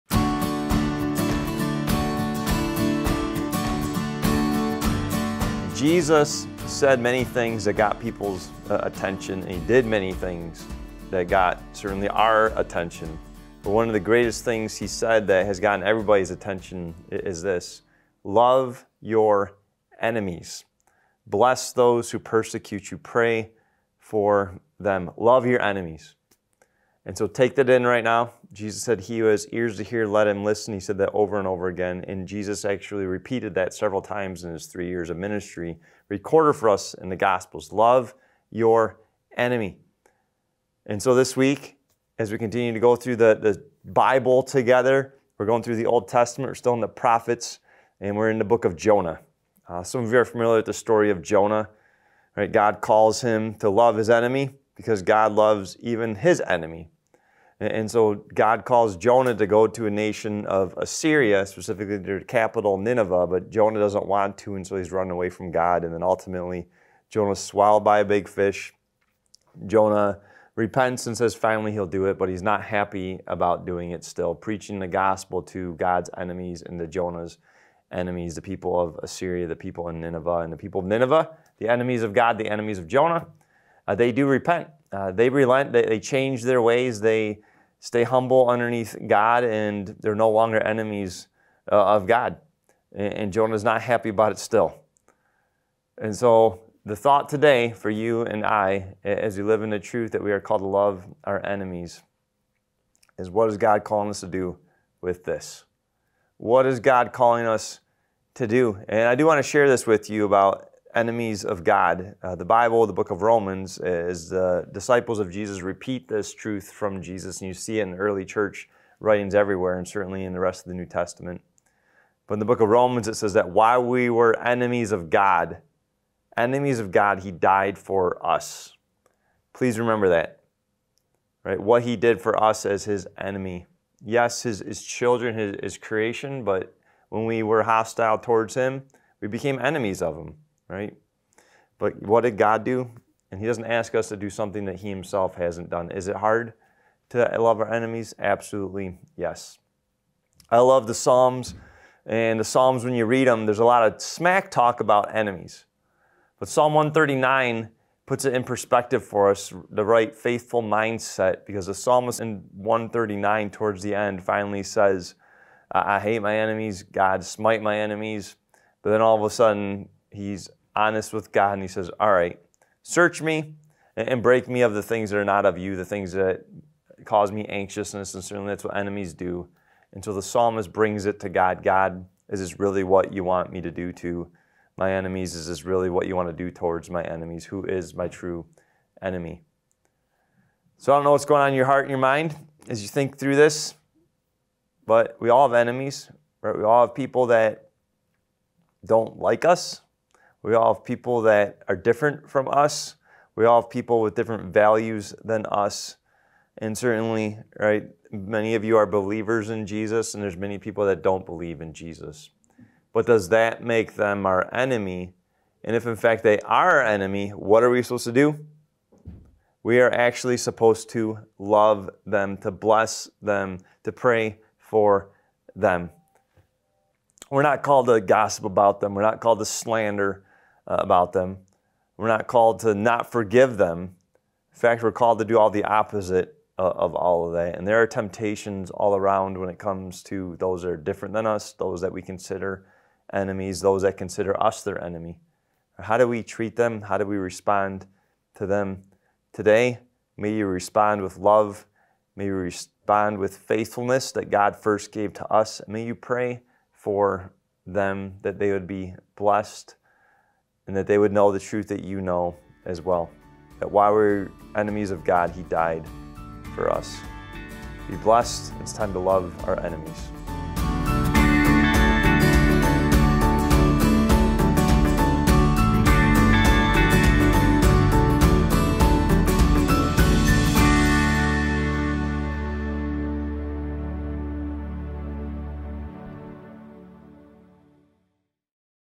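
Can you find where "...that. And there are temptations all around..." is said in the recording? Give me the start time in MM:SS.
03:57.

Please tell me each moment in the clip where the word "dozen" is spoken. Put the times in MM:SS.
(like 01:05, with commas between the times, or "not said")
not said.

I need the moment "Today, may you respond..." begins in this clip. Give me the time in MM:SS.
04:09.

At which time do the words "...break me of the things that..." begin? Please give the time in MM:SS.
02:54.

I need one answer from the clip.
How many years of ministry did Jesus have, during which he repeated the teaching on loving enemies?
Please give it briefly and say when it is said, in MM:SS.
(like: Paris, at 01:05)
3, at 00:34.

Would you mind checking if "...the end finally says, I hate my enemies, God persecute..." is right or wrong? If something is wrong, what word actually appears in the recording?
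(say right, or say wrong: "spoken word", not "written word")
wrong: "smite", not "persecute".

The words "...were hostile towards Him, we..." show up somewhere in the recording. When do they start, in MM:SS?
02:17.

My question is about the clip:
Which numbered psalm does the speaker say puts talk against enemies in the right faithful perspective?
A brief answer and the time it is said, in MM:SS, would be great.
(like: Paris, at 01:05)
Psalm 139, at 02:36.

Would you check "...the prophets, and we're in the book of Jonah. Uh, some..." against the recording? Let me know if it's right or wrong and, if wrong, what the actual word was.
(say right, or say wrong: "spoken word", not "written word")
right.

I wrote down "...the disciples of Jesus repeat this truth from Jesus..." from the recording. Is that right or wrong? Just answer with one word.
right.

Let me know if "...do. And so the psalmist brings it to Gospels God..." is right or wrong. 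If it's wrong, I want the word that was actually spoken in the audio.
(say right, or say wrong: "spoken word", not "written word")
wrong: "God", not "Gospels".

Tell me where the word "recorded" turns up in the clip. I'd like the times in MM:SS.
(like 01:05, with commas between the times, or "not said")
00:36.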